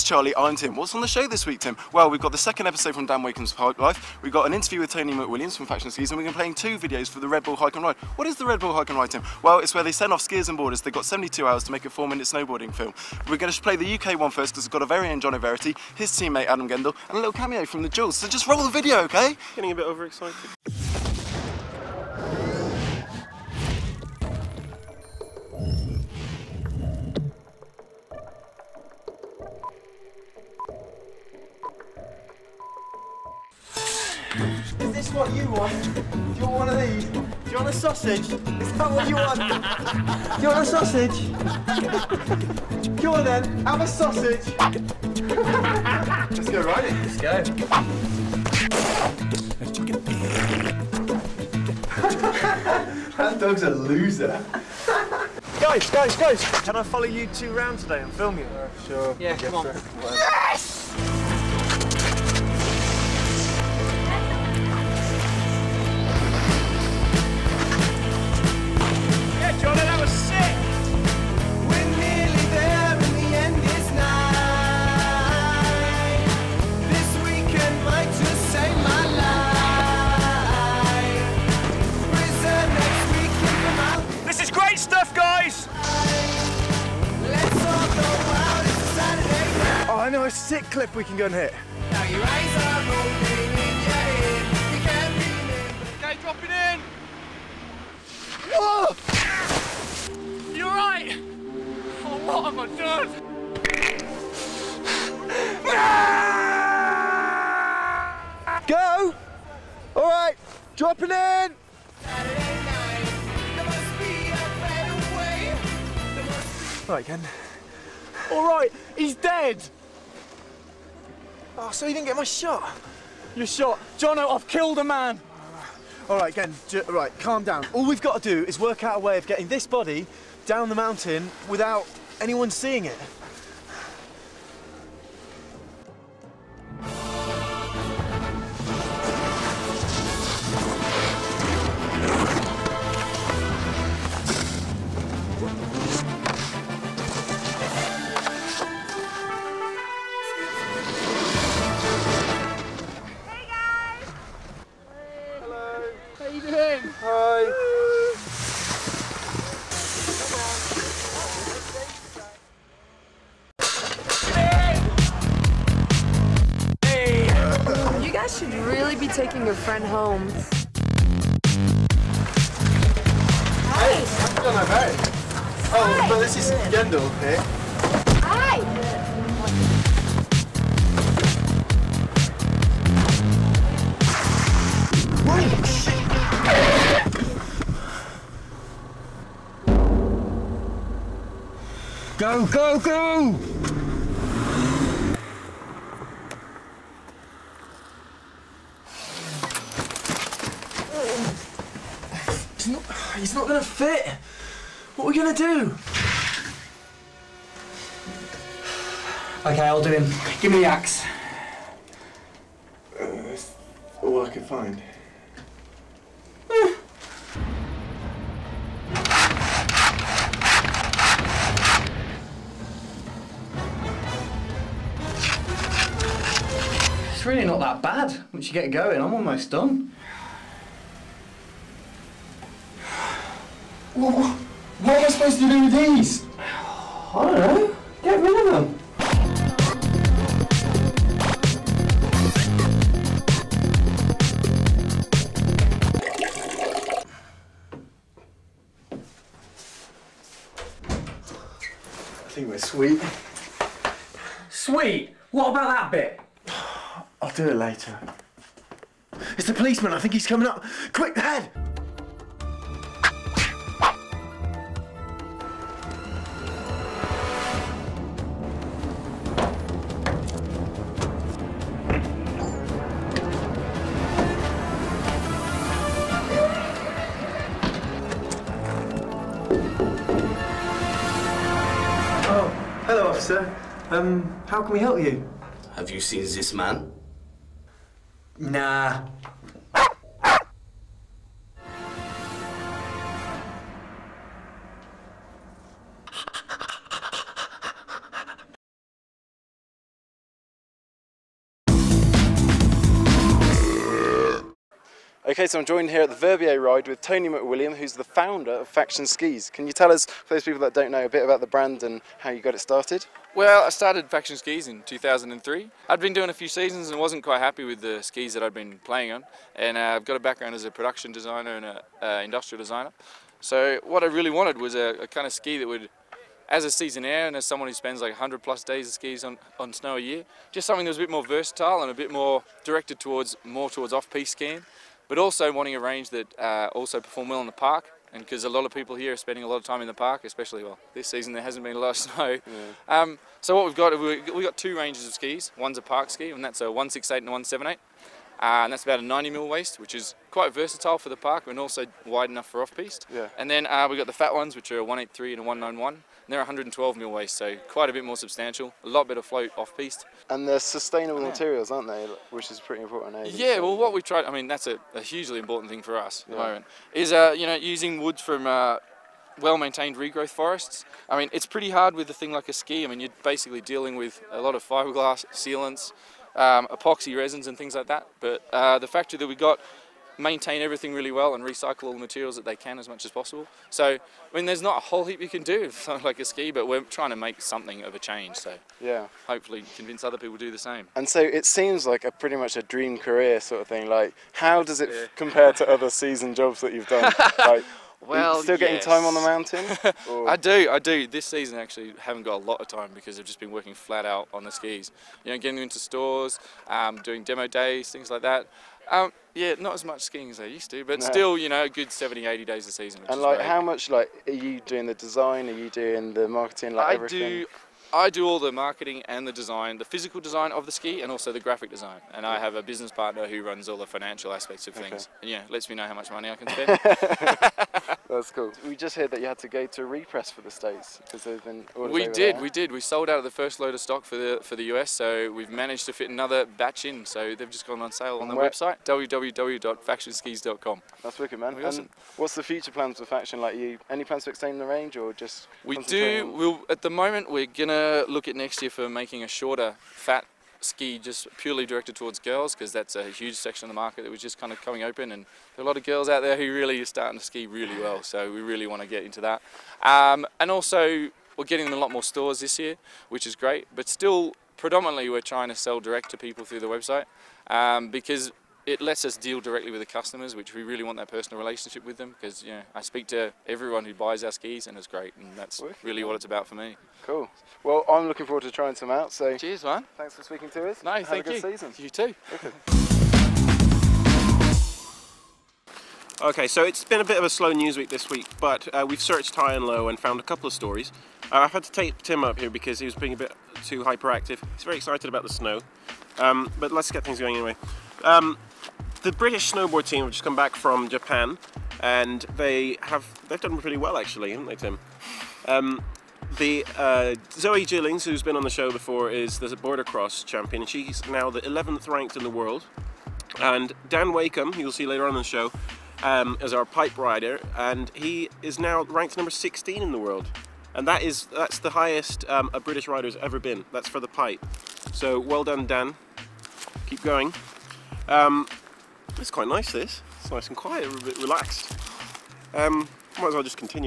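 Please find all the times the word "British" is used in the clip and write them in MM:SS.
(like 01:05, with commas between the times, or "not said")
08:19, 08:42.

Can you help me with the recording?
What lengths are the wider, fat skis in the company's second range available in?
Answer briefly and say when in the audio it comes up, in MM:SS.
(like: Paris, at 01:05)
183 and 191, at 05:54.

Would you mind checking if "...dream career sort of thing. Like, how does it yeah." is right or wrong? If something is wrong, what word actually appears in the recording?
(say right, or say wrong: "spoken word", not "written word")
right.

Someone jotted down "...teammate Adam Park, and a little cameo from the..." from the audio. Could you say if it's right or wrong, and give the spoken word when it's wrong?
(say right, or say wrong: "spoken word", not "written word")
wrong: "Gendle", not "Park".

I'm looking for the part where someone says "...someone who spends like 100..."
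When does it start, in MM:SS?
05:27.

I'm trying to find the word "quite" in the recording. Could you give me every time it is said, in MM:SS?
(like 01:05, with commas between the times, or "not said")
05:17, 05:50, 05:57, 08:49.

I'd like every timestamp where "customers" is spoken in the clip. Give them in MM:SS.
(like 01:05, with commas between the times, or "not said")
07:49.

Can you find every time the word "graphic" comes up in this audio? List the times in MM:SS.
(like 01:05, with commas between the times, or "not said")
07:01.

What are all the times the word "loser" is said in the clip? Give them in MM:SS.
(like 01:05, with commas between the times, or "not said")
00:53.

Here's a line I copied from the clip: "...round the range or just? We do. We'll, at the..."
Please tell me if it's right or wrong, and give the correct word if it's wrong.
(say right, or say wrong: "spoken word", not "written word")
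wrong: "extend", not "round".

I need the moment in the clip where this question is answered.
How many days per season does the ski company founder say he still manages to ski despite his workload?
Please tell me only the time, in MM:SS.
06:51.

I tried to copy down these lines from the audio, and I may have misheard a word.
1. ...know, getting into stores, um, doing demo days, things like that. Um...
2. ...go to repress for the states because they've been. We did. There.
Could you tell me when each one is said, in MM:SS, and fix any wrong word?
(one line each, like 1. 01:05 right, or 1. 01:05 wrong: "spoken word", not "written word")
1. 06:45 right
2. 07:09 right.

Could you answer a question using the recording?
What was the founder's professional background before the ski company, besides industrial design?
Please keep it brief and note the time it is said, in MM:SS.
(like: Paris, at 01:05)
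Production designer, at 05:20.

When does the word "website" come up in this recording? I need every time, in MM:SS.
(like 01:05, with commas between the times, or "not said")
07:18, 07:46.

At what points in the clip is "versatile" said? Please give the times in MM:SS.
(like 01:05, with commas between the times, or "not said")
05:31, 05:50.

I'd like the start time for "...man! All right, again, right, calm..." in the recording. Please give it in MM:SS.
02:04.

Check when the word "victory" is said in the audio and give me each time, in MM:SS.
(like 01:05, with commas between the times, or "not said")
not said.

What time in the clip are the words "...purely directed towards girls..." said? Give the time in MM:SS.
07:31.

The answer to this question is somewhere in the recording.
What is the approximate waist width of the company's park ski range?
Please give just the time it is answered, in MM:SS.
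05:49.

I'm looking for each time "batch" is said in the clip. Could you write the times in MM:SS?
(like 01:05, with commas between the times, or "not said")
07:16.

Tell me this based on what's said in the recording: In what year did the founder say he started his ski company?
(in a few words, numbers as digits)
2003.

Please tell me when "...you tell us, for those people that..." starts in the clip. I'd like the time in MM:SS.
05:09.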